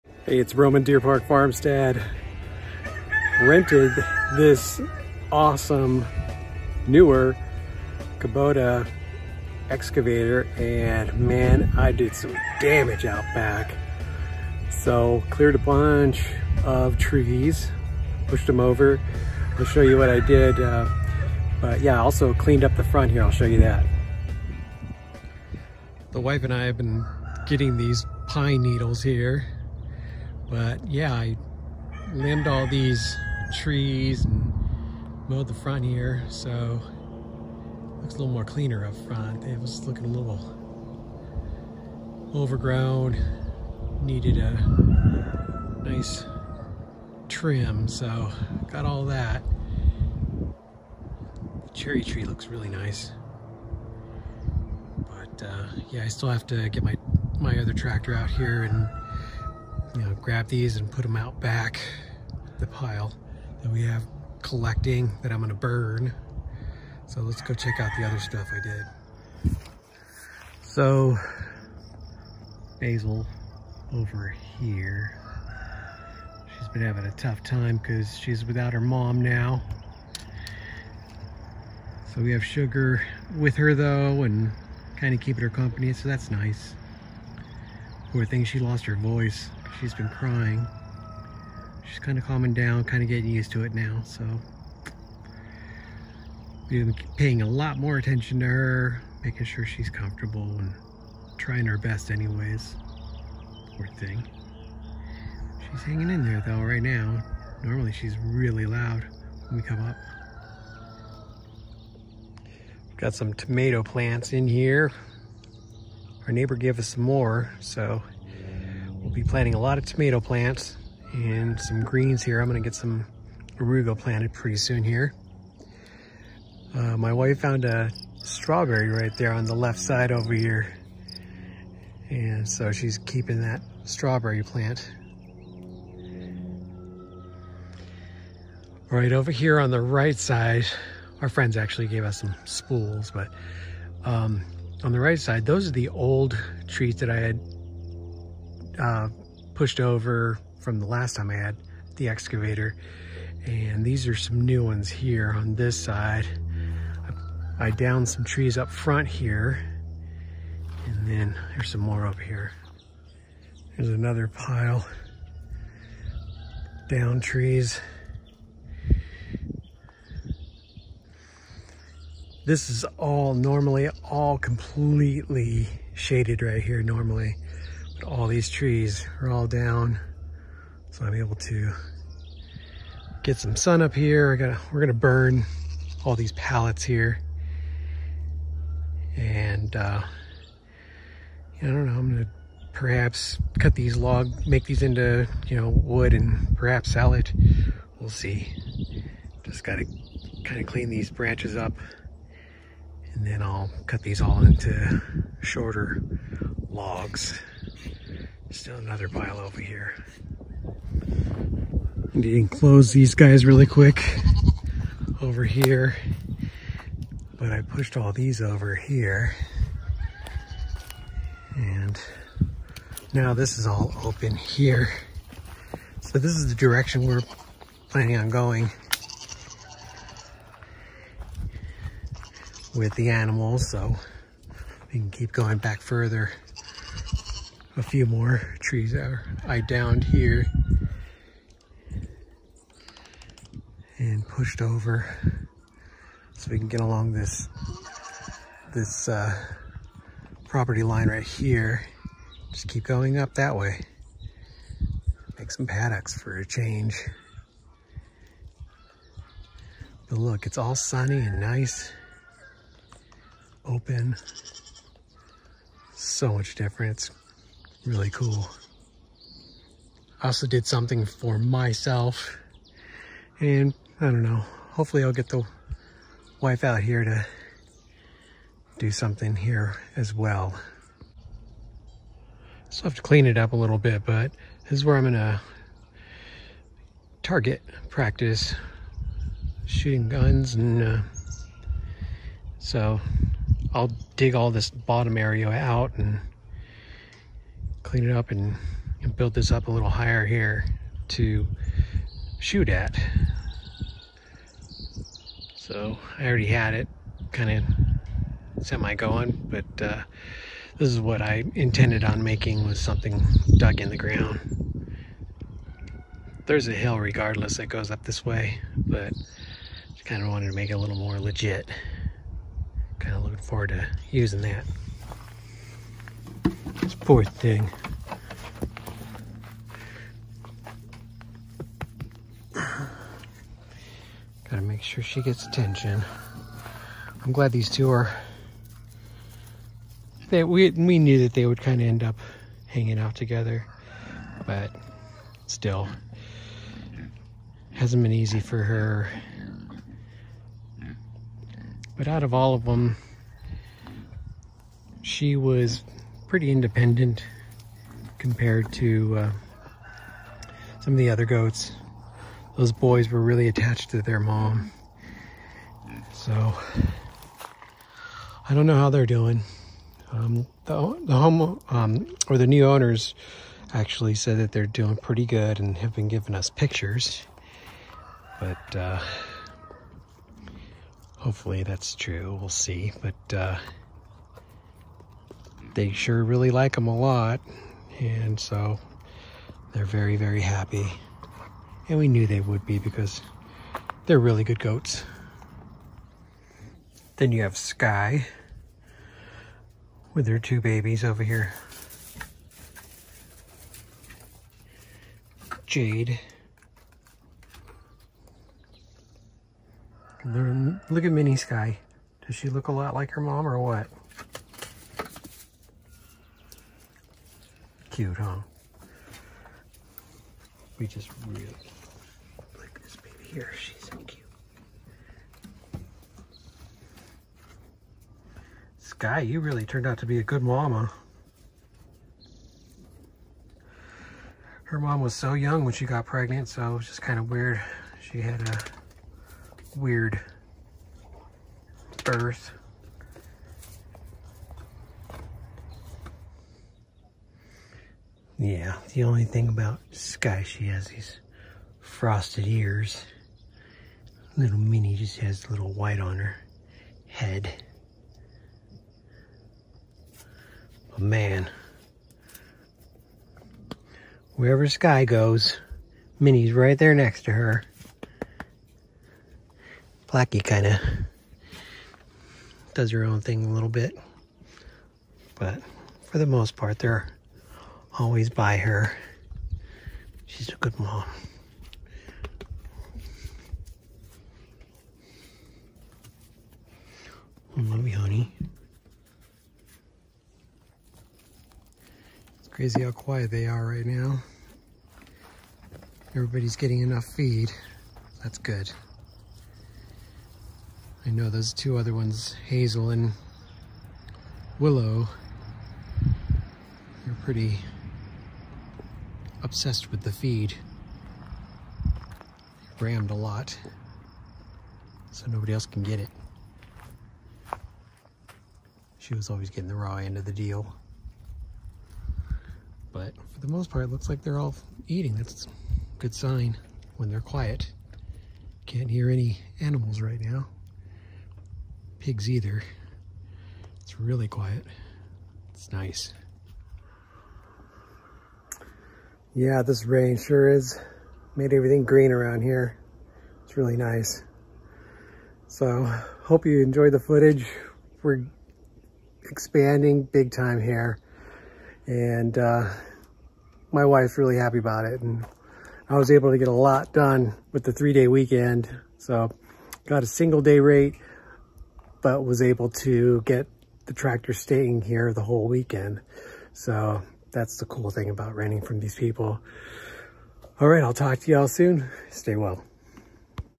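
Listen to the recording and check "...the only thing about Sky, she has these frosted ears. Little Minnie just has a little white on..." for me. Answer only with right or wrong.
right.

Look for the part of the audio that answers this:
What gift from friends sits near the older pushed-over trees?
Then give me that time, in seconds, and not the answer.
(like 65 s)
142 s.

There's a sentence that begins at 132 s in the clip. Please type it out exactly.
And so she's keeping that strawberry plant.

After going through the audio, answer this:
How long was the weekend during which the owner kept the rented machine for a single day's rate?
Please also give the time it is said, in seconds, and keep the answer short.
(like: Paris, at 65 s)
3 days, at 557 s.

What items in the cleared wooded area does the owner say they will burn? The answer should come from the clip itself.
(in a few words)
pallets.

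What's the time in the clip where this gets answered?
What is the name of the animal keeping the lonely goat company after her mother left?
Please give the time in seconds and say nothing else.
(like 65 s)
82 s.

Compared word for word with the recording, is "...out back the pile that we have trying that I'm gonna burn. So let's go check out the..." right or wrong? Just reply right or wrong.
wrong.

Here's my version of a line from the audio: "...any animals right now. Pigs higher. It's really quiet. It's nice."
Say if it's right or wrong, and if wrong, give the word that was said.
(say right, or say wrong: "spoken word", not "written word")
wrong: "either", not "higher".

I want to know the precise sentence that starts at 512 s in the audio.
rammed a lot, so nobody else can get it.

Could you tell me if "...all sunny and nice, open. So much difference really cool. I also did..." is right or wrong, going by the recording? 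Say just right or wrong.
right.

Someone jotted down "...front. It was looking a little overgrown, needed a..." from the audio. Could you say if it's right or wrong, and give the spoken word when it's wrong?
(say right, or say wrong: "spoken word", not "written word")
right.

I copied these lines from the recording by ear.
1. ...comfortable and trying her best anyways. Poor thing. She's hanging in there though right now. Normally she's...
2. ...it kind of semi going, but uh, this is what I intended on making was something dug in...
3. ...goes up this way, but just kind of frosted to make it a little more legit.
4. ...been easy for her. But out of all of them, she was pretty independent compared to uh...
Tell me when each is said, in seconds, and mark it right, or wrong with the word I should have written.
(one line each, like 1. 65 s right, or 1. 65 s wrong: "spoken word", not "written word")
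1. 99 s right
2. 306 s right
3. 317 s wrong: "wanted", not "frosted"
4. 348 s right.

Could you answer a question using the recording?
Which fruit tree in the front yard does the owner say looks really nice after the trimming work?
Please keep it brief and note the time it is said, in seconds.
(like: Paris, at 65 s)
cherry tree, at 51 s.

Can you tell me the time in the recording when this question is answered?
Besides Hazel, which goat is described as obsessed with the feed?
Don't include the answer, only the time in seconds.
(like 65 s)
504 s.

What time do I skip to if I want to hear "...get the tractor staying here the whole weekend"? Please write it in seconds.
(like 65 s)
563 s.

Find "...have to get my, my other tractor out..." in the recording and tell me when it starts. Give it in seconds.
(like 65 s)
56 s.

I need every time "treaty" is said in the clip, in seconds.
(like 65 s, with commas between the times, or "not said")
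not said.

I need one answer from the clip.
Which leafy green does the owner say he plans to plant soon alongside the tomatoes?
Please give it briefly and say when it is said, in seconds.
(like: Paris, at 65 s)
arugula, at 123 s.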